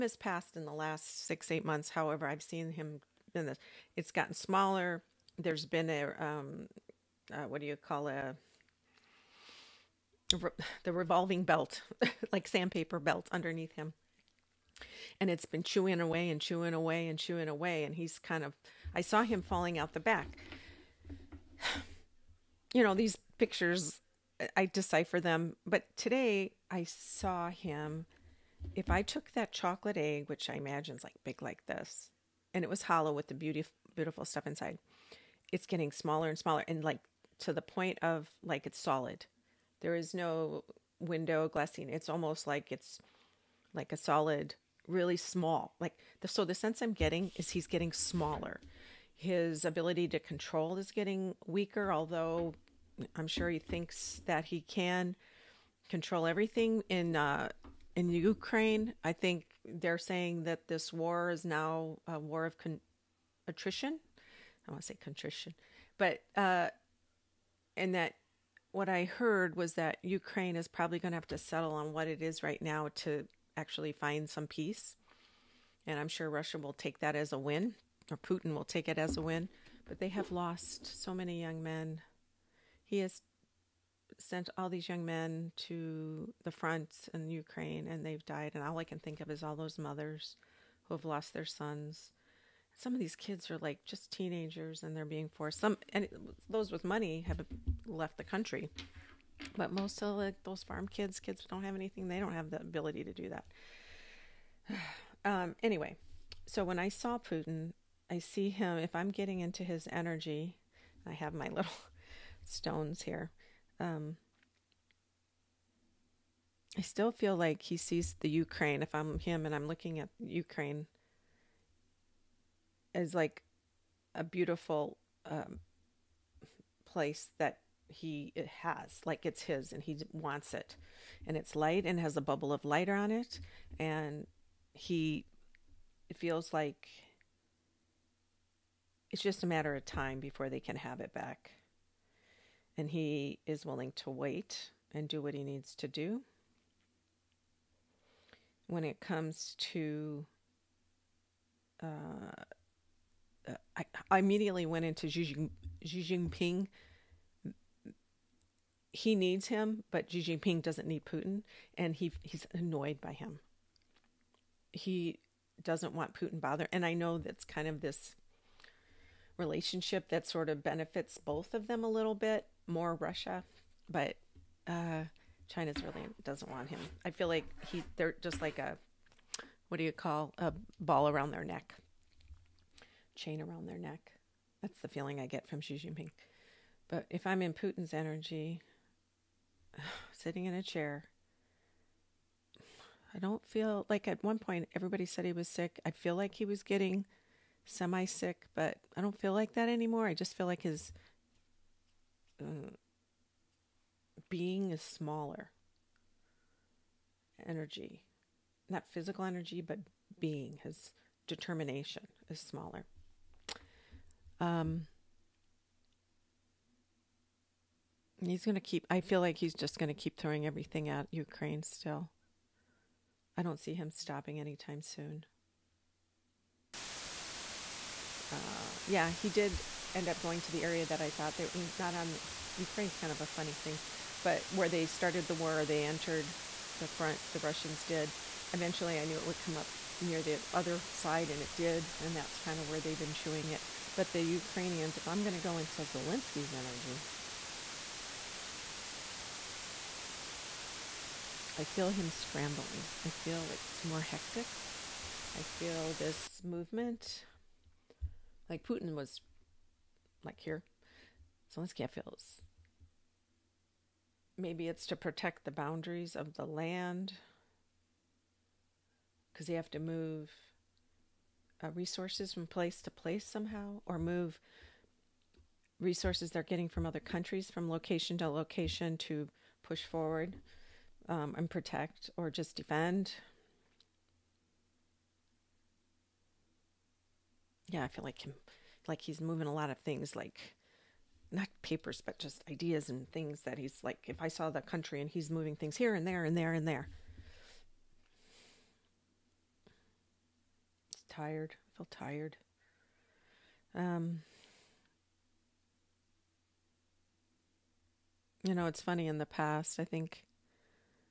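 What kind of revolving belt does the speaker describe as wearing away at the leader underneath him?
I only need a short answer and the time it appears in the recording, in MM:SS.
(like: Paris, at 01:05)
sandpaper belt, at 00:12.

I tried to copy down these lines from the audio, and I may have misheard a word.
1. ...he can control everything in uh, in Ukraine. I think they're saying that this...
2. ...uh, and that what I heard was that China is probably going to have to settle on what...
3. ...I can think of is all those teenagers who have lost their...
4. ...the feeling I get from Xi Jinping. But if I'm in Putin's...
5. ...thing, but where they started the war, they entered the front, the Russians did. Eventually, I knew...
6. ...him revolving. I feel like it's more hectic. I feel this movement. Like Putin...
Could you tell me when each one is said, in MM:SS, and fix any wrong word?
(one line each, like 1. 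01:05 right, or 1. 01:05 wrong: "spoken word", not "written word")
1. 00:54 right
2. 01:06 wrong: "Ukraine", not "China"
3. 01:28 wrong: "mothers", not "teenagers"
4. 03:04 right
5. 03:53 right
6. 04:11 wrong: "scrambling", not "revolving".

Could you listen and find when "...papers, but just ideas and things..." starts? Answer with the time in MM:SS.
04:51.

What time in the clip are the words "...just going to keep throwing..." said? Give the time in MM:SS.
03:39.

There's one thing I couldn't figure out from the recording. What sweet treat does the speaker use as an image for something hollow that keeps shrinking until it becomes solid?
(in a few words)
chocolate egg.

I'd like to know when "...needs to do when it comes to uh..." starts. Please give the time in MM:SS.
02:25.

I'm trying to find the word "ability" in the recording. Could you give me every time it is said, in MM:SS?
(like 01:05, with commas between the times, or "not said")
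00:49, 01:42.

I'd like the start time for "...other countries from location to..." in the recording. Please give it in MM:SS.
04:36.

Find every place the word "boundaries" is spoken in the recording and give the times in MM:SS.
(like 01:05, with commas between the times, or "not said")
04:25.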